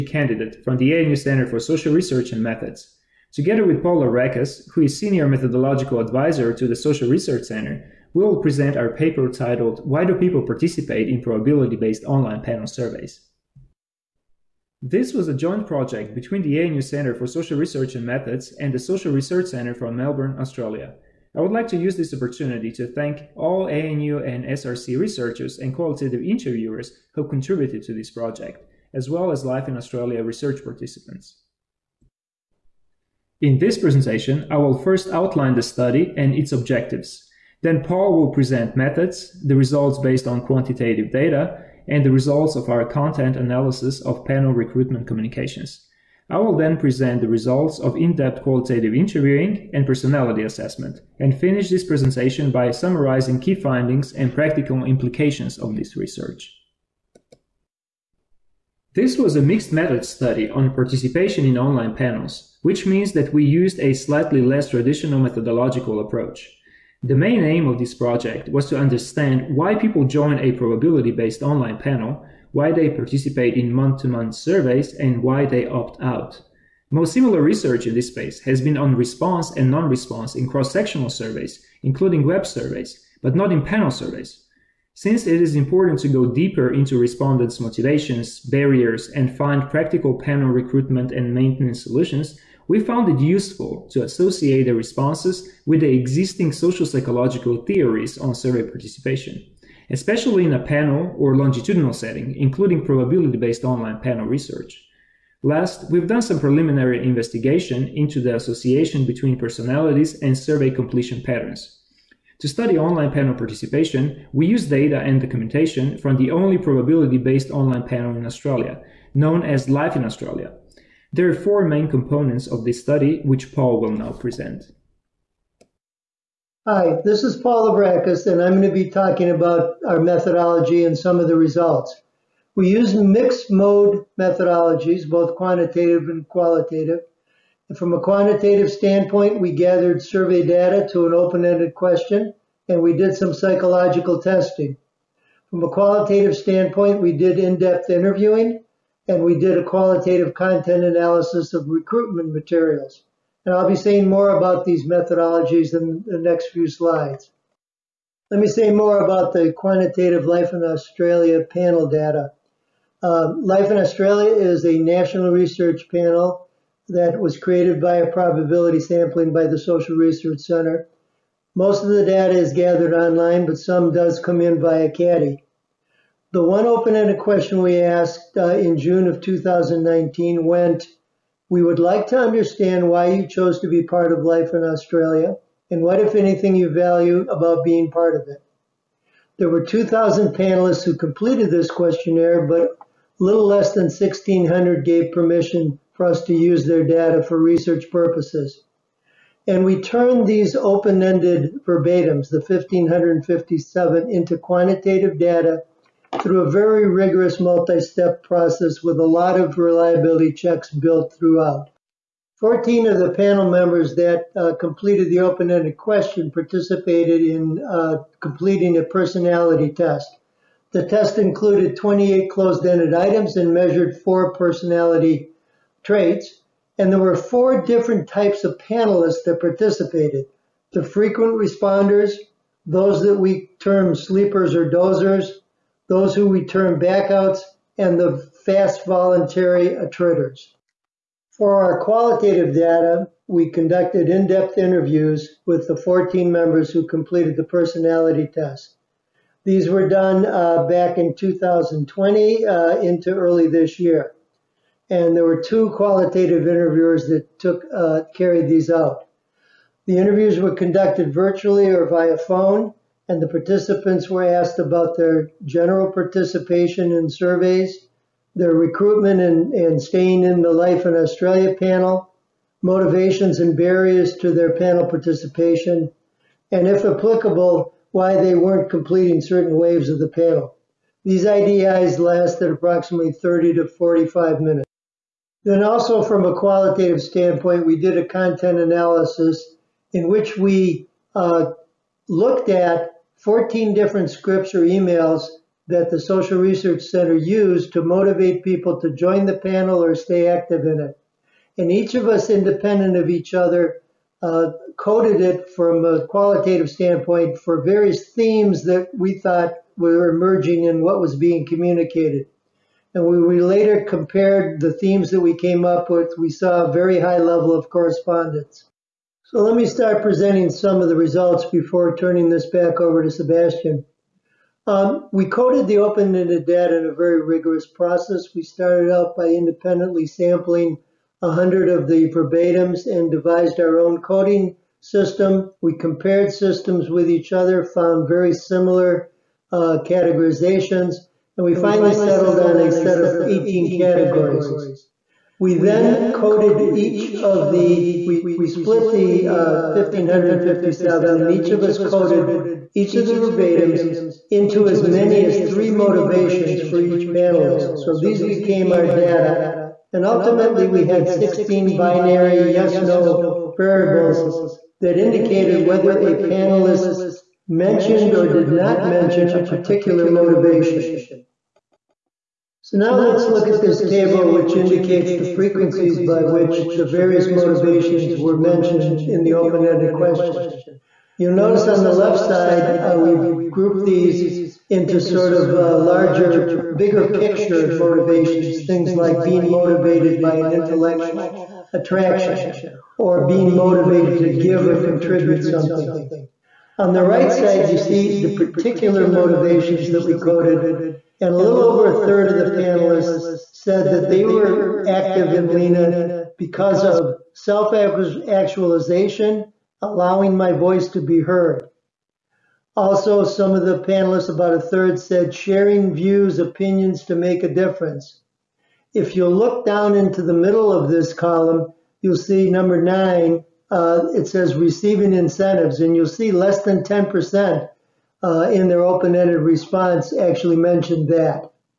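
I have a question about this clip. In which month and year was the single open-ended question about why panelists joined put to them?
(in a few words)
June 2019.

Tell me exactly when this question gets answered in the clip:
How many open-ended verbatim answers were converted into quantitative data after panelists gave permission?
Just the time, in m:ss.
3:22.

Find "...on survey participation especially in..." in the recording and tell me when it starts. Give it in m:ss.
1:38.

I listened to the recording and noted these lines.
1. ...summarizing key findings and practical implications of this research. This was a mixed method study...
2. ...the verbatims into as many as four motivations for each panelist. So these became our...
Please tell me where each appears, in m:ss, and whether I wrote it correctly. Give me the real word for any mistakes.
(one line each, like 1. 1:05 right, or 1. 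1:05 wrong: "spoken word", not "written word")
1. 0:52 right
2. 5:53 wrong: "three", not "four".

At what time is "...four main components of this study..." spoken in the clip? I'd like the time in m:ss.
2:01.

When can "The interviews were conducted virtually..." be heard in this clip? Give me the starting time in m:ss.
4:19.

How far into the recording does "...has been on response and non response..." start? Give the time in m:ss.
1:18.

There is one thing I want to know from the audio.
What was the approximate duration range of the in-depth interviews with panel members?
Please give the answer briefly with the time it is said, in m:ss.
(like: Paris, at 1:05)
30 to 45 minutes, at 4:43.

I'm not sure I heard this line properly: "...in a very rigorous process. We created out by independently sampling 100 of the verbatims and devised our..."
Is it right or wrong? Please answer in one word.
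wrong.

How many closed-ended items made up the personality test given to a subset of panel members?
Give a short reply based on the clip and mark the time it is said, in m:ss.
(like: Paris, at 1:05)
28, at 3:41.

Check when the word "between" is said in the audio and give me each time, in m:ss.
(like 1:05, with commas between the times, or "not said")
0:16, 1:49.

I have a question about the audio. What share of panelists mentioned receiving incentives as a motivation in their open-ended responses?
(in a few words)
less than 10%.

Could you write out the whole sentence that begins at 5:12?
And when we later compared the themes that we came up with, we saw a very high level of correspondence.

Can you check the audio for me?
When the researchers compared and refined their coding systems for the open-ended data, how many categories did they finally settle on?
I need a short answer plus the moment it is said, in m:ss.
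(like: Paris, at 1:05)
18, at 5:43.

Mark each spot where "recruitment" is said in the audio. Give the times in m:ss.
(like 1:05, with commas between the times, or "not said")
0:44, 1:30, 2:31, 4:28.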